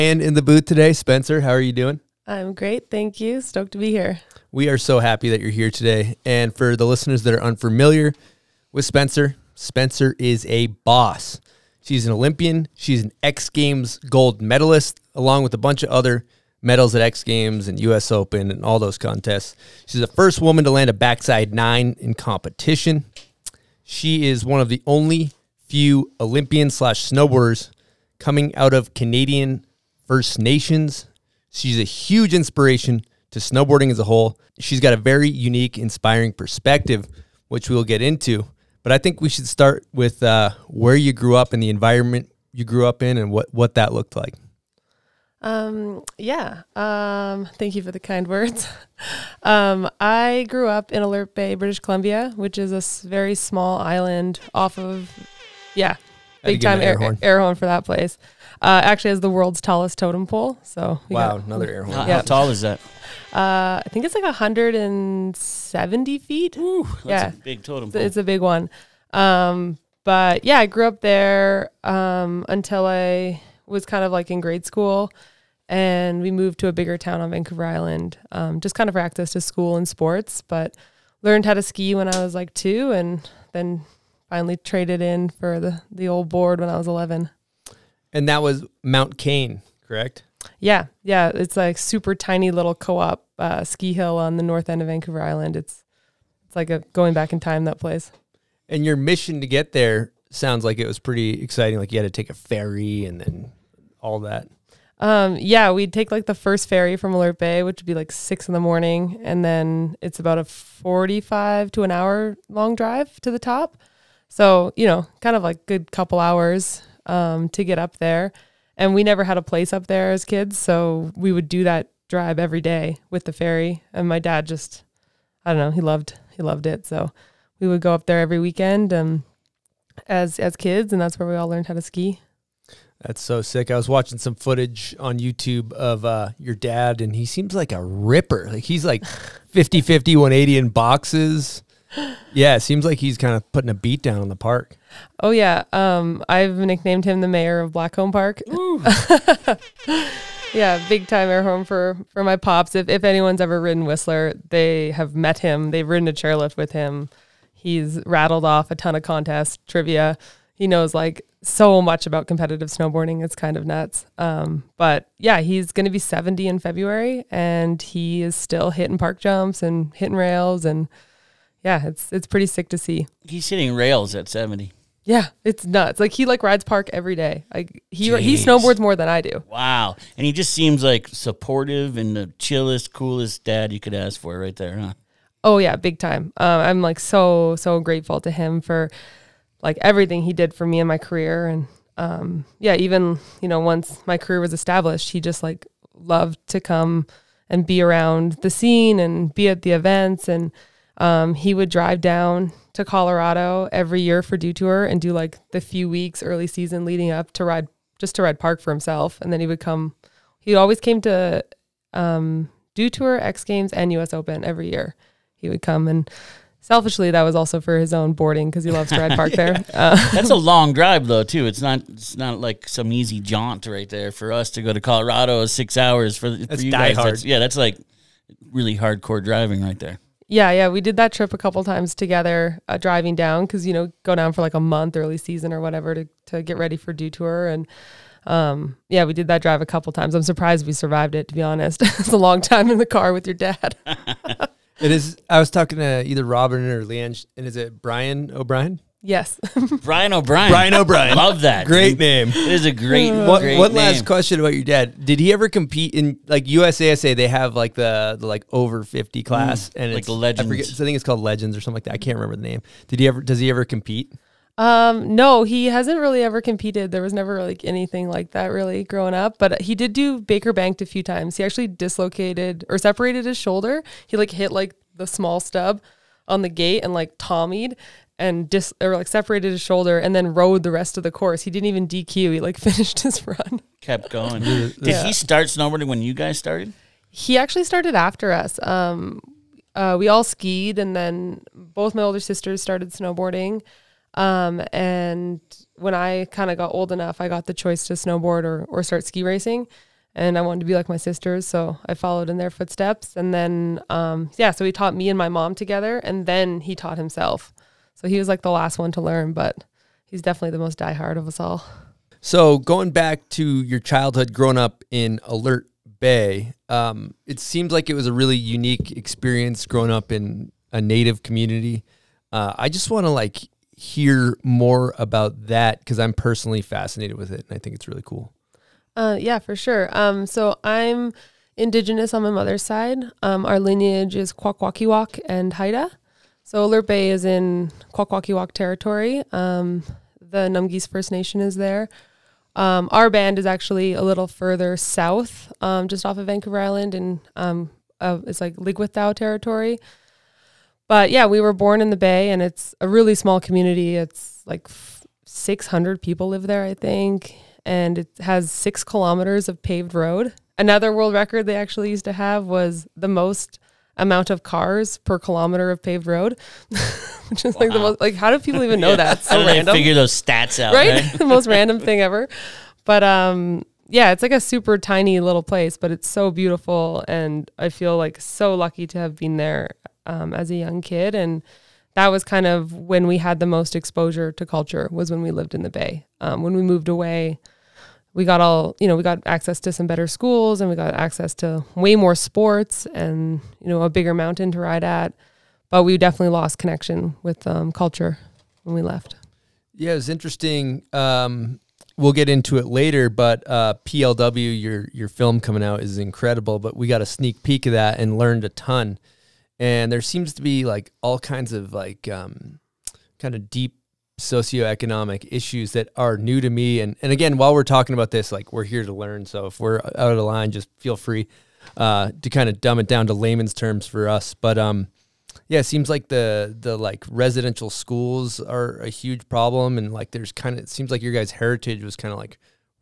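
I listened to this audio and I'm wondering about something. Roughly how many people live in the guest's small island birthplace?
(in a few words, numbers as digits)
600.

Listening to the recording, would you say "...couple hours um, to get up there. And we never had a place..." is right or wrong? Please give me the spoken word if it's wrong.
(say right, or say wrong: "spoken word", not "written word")
right.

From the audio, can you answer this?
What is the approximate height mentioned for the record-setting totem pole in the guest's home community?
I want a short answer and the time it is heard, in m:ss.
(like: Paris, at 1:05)
170 feet, at 1:04.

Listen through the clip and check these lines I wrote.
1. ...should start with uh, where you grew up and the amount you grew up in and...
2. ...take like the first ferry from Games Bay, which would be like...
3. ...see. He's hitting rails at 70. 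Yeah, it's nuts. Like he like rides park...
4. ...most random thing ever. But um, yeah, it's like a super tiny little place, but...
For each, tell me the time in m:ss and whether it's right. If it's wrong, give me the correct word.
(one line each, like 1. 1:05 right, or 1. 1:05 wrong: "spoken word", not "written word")
1. 0:39 wrong: "environment", not "amount"
2. 1:45 wrong: "Alert", not "Games"
3. 2:52 right
4. 6:11 right.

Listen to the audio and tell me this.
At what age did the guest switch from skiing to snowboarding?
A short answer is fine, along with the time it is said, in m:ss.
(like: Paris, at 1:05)
11, at 1:26.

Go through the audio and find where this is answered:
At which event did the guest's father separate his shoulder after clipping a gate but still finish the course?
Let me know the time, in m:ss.
4:30.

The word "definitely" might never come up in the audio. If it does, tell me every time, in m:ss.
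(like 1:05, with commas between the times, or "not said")
5:10, 6:35.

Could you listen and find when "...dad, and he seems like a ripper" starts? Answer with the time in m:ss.
2:16.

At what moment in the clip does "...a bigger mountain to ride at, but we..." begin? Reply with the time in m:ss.
6:33.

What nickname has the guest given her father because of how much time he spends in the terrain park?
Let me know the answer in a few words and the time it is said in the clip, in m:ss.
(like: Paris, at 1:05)
Mayor of Blackcomb Park, at 2:27.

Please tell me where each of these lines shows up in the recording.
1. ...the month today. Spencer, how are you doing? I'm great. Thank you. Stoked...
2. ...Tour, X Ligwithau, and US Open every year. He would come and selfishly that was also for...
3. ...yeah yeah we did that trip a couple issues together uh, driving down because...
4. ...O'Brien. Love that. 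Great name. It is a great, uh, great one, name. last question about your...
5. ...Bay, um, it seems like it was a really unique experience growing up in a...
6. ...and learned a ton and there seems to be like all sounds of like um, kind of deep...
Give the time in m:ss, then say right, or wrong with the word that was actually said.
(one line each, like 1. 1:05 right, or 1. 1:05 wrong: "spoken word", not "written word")
1. 0:00 wrong: "booth", not "month"
2. 3:32 wrong: "Games", not "Ligwithau"
3. 3:50 wrong: "times", not "issues"
4. 4:10 right
5. 5:15 right
6. 6:47 wrong: "kinds", not "sounds".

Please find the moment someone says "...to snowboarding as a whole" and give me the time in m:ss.
0:33.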